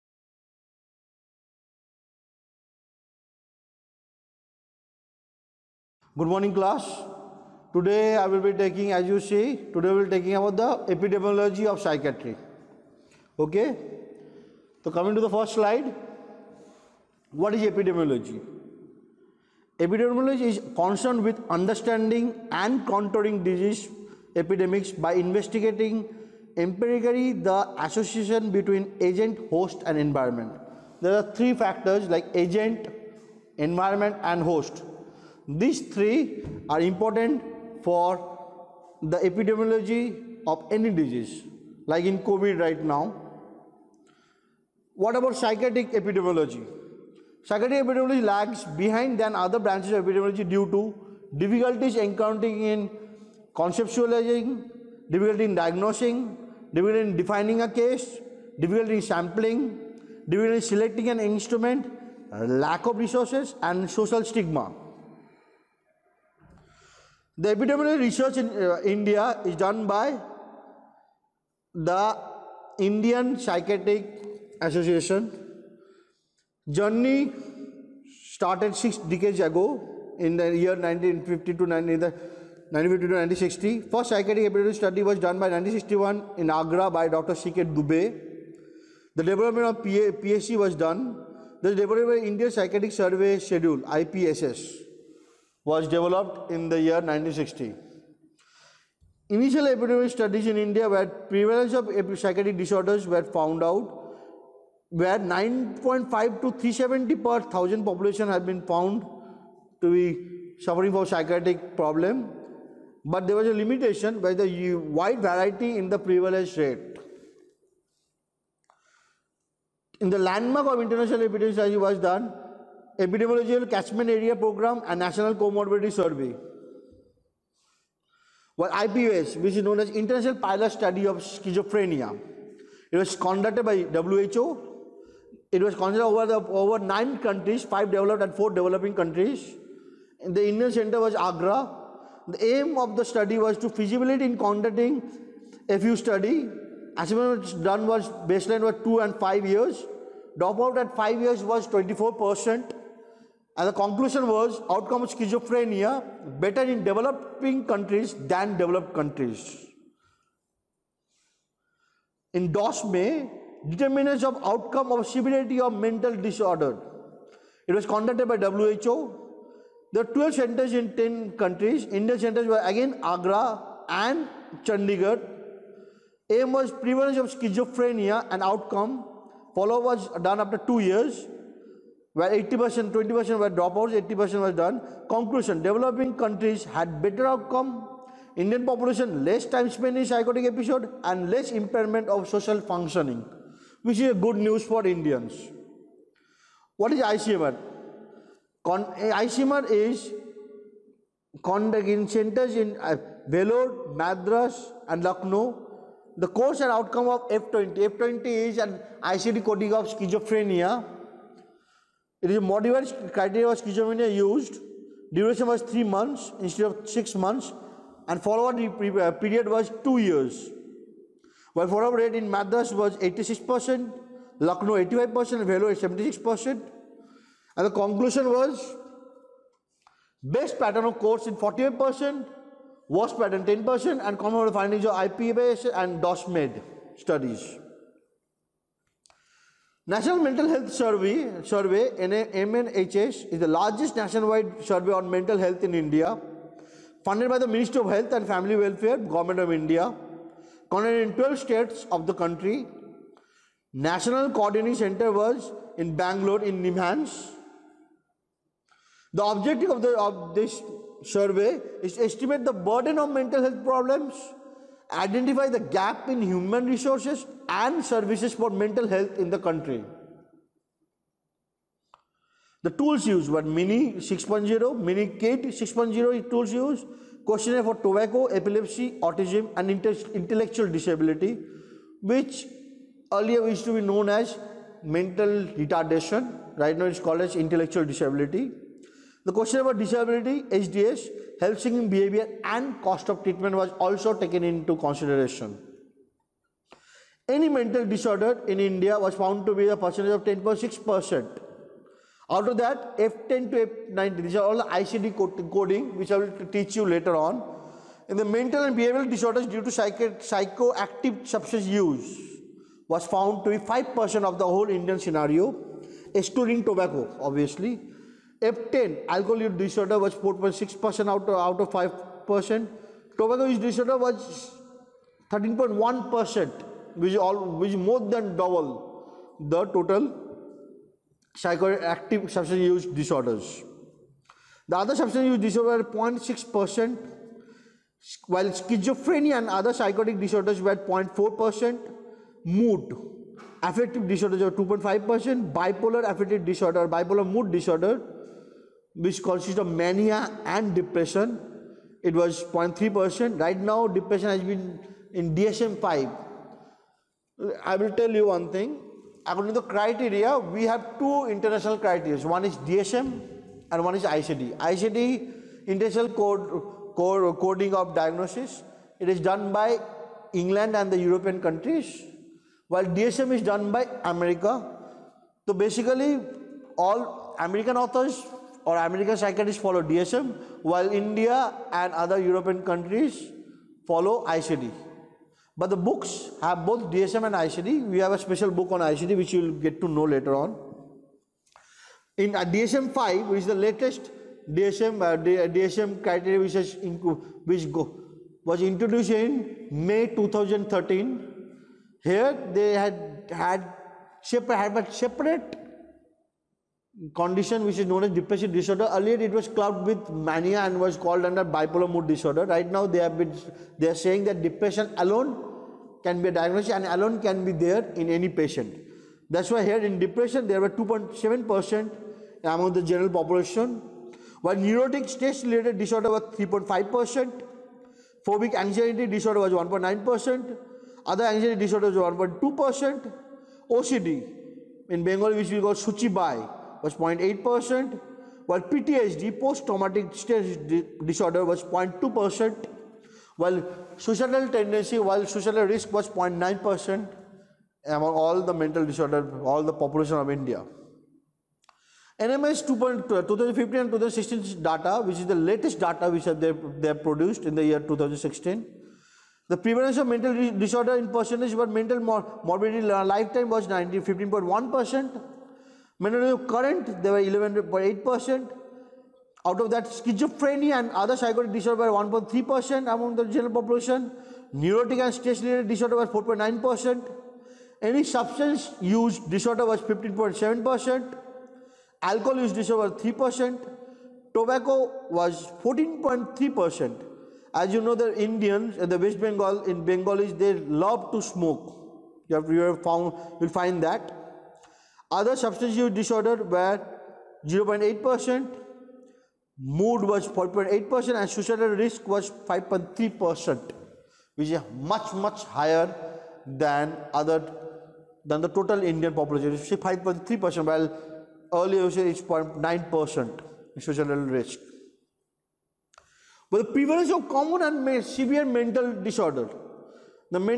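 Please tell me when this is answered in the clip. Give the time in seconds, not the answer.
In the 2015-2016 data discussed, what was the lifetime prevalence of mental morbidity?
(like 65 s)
463 s.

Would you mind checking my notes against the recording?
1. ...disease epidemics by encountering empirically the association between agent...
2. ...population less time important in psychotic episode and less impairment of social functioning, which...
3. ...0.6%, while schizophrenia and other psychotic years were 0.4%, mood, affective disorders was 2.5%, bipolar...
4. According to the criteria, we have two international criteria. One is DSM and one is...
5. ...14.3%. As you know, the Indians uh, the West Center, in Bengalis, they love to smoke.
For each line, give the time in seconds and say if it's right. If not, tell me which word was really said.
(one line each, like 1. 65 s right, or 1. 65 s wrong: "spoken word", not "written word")
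1. 23 s wrong: "investigating", not "encountering"
2. 188 s wrong: "spent", not "important"
3. 336 s wrong: "disorders", not "years"
4. 359 s right
5. 485 s wrong: "Bengal", not "Center".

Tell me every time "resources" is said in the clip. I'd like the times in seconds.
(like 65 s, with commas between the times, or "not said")
62 s, 266 s.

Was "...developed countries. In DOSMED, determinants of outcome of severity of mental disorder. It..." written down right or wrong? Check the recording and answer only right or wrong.
right.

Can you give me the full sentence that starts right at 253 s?
National Coordinating Center was in Bangalore in Nimhans.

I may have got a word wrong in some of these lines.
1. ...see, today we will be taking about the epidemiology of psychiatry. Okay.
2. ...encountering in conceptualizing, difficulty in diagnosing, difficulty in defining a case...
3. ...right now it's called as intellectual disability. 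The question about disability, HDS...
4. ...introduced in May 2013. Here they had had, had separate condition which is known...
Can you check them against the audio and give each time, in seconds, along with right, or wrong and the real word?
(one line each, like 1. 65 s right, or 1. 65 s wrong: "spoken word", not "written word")
1. 9 s right
2. 51 s right
3. 286 s right
4. 398 s right.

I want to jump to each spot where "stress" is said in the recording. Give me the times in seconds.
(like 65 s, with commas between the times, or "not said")
425 s, 440 s, 475 s.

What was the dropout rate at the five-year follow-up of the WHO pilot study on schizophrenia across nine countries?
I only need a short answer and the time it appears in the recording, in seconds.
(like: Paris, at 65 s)
24%, at 151 s.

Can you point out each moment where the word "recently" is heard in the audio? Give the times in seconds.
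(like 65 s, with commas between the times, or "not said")
not said.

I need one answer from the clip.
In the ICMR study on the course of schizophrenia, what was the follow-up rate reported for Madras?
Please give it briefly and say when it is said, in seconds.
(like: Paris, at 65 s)
86%, at 222 s.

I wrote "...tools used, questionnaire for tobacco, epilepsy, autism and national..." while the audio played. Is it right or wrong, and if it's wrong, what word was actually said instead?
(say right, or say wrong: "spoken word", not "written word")
wrong: "intellectual", not "national".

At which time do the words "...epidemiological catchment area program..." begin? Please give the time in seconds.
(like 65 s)
122 s.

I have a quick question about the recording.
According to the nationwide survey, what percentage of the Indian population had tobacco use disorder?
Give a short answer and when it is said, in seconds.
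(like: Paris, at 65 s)
13.1%, at 325 s.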